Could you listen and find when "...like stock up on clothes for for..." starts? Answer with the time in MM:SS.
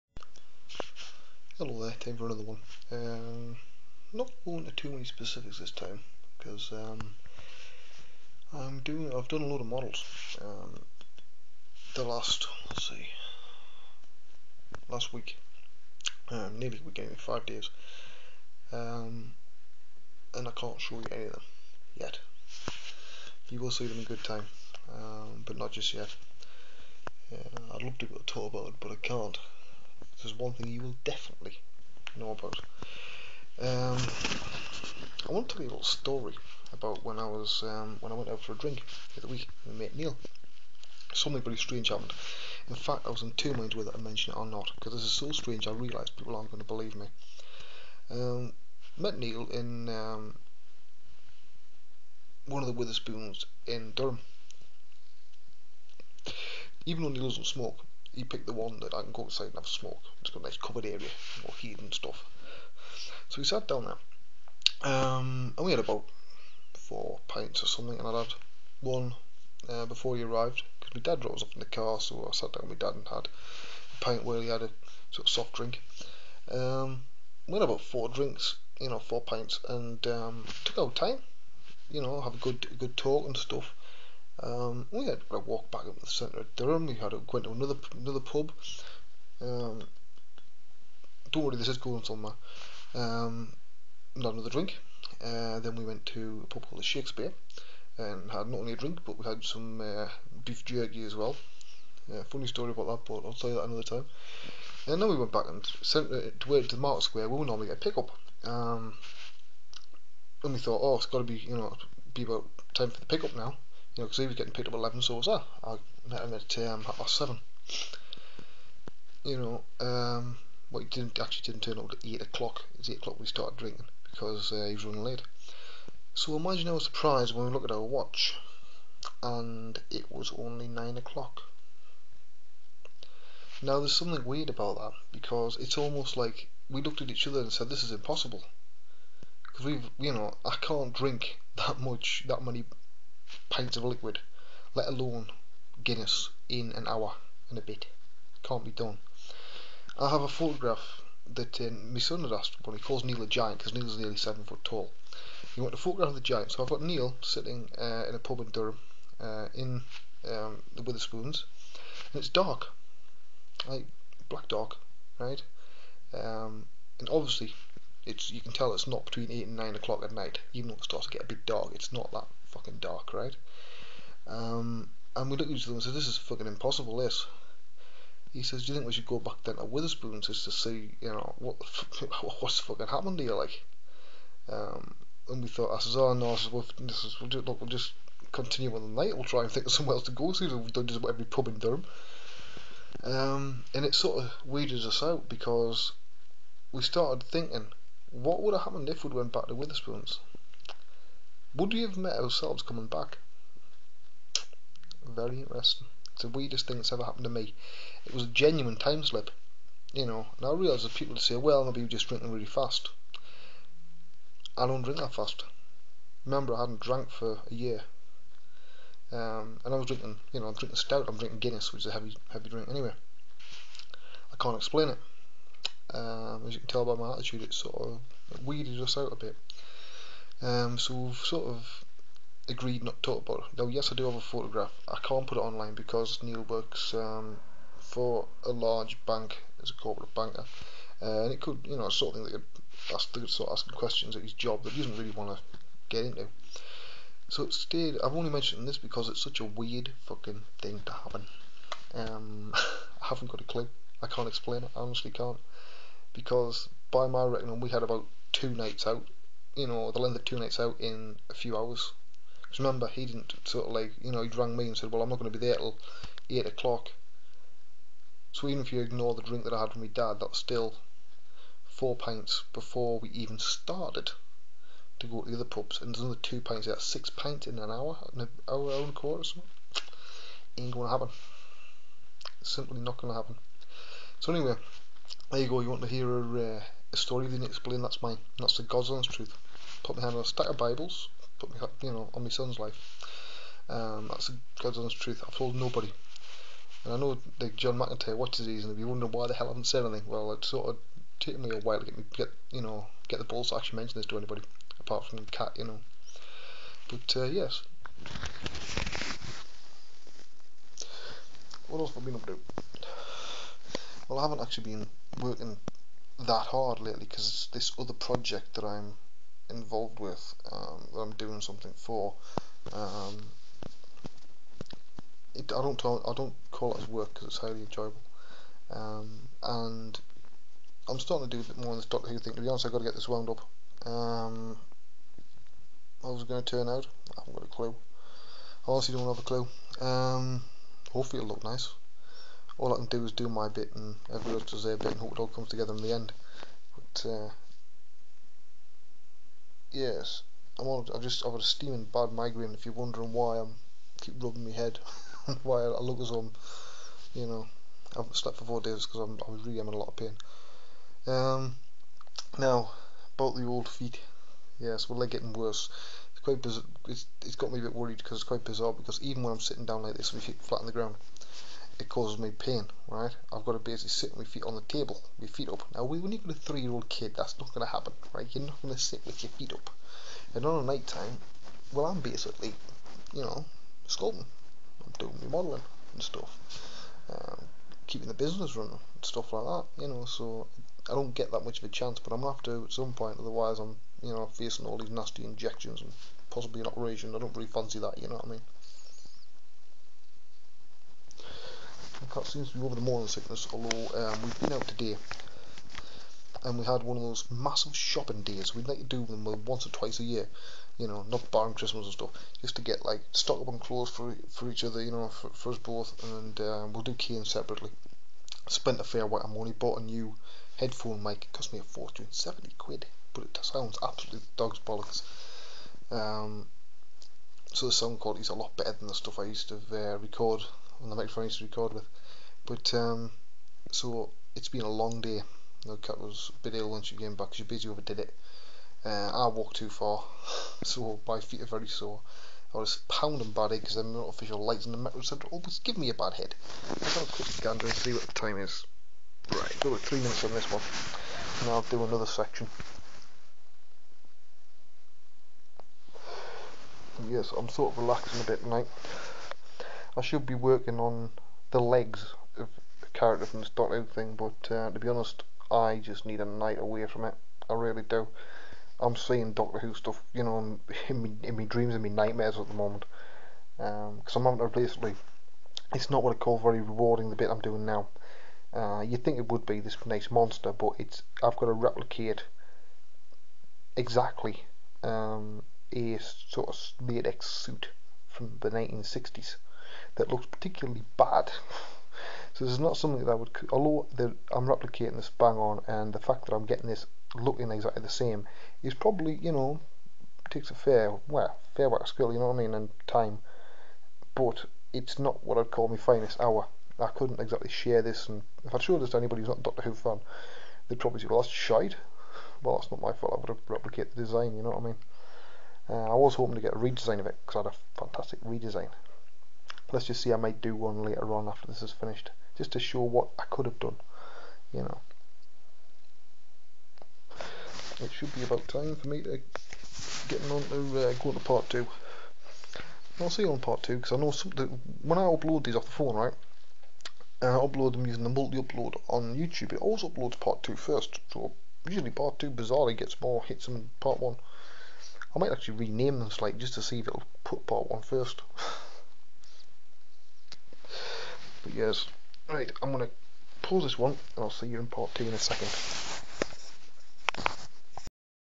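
06:52.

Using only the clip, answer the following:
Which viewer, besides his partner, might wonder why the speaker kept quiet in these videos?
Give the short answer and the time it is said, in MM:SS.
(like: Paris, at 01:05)
John McIntyre, at 04:57.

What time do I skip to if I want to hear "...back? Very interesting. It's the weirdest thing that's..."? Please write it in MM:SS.
03:22.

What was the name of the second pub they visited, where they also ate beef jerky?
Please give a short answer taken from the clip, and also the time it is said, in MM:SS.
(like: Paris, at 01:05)
the Shakespeare, at 01:36.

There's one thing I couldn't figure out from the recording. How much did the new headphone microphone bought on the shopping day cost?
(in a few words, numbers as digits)
70 quid.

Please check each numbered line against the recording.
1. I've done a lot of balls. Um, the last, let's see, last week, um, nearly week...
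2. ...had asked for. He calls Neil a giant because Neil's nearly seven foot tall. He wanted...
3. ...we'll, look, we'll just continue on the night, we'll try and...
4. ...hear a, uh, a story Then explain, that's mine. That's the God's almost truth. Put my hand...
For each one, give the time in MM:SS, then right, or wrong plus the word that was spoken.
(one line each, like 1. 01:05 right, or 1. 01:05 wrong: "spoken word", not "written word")
1. 00:09 wrong: "models", not "balls"
2. 02:32 right
3. 03:07 right
4. 04:45 wrong: "honest", not "almost".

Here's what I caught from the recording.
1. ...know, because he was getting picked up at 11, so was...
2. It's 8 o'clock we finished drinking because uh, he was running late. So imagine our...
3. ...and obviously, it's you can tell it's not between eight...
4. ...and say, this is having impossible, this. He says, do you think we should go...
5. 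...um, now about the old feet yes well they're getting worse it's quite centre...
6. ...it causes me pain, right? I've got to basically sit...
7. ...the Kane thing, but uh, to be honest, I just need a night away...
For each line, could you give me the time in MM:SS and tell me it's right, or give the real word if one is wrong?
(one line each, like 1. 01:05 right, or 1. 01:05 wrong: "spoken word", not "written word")
1. 01:54 right
2. 02:02 wrong: "started", not "finished"
3. 02:46 right
4. 02:55 wrong: "fucking", not "having"
5. 06:01 wrong: "bizarre", not "centre"
6. 06:11 right
7. 07:43 wrong: "Scotland", not "Kane".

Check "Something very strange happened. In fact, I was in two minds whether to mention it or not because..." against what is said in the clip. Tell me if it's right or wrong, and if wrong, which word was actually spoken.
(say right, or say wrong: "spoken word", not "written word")
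right.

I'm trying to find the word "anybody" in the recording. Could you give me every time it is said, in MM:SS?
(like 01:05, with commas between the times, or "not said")
05:04, 08:28.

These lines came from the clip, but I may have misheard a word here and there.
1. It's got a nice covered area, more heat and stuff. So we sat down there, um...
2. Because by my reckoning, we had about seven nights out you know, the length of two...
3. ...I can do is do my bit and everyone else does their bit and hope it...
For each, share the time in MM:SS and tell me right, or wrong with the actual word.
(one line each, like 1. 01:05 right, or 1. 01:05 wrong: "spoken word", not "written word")
1. 01:00 right
2. 04:16 wrong: "two", not "seven"
3. 05:42 right.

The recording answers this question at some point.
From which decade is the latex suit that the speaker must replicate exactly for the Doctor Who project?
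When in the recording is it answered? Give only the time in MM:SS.
08:08.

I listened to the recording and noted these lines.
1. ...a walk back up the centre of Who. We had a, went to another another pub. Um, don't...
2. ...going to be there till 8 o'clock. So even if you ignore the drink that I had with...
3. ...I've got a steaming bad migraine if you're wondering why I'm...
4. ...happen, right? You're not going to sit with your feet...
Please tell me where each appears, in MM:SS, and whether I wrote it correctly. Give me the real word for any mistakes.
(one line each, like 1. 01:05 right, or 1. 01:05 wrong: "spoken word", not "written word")
1. 01:25 wrong: "Durham", not "Who"
2. 04:25 right
3. 05:51 right
4. 06:17 right.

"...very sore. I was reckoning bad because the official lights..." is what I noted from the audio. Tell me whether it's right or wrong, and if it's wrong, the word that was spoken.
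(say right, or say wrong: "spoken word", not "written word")
wrong: "pounding", not "reckoning".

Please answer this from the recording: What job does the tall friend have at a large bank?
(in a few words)
corporate banker.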